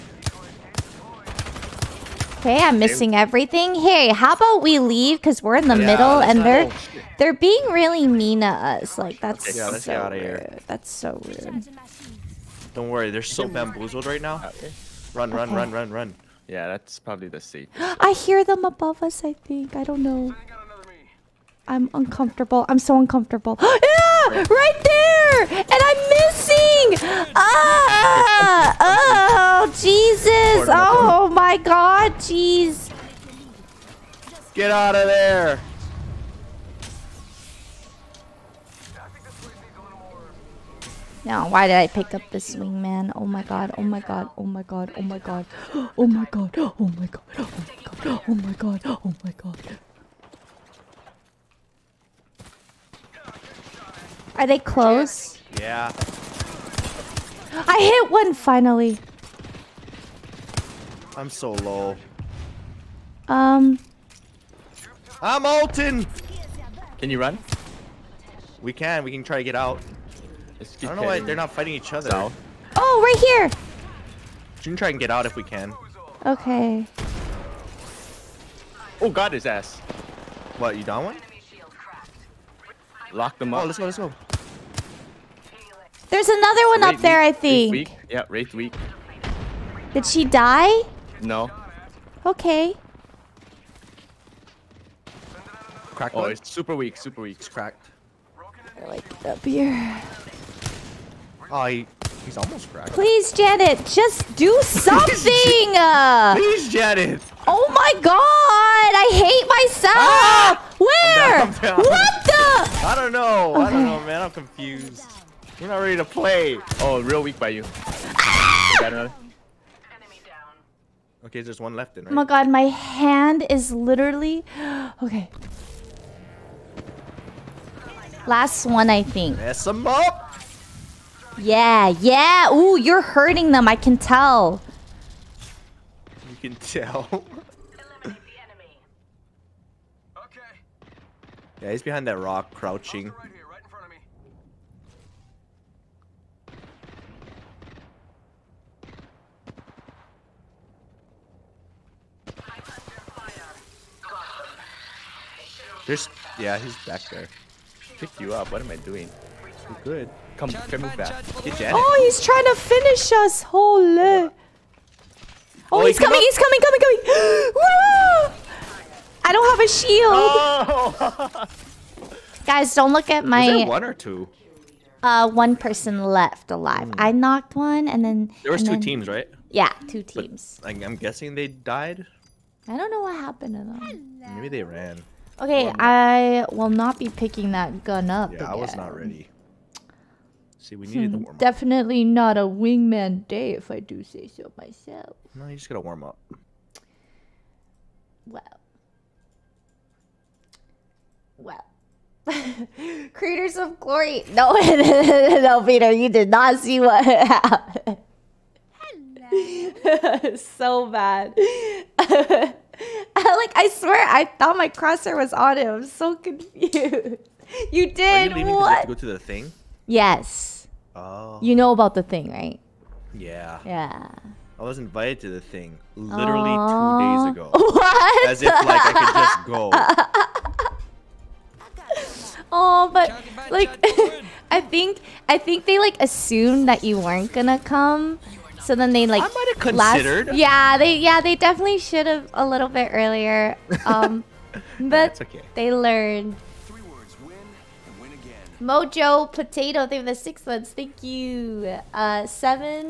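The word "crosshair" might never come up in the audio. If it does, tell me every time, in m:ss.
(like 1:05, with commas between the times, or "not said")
3:34.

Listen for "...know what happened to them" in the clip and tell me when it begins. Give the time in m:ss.
3:02.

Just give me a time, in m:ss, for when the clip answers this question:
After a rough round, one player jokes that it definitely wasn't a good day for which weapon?
3:12.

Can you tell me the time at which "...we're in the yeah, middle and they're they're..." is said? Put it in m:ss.
0:05.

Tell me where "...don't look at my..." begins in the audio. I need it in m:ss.
2:52.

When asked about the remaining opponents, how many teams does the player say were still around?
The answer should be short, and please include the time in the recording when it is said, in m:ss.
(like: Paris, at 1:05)
2, at 2:59.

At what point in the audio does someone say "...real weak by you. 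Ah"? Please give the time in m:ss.
1:57.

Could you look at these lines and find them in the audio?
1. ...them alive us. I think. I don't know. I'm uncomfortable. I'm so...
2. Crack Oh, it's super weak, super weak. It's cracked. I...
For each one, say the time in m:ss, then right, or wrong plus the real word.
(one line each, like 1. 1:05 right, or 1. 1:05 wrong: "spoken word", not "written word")
1. 0:18 wrong: "above", not "alive"
2. 1:35 right.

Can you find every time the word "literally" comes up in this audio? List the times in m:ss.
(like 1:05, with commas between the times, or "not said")
2:03, 3:45.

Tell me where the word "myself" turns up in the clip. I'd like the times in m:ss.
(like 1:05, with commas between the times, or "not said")
1:49, 3:14.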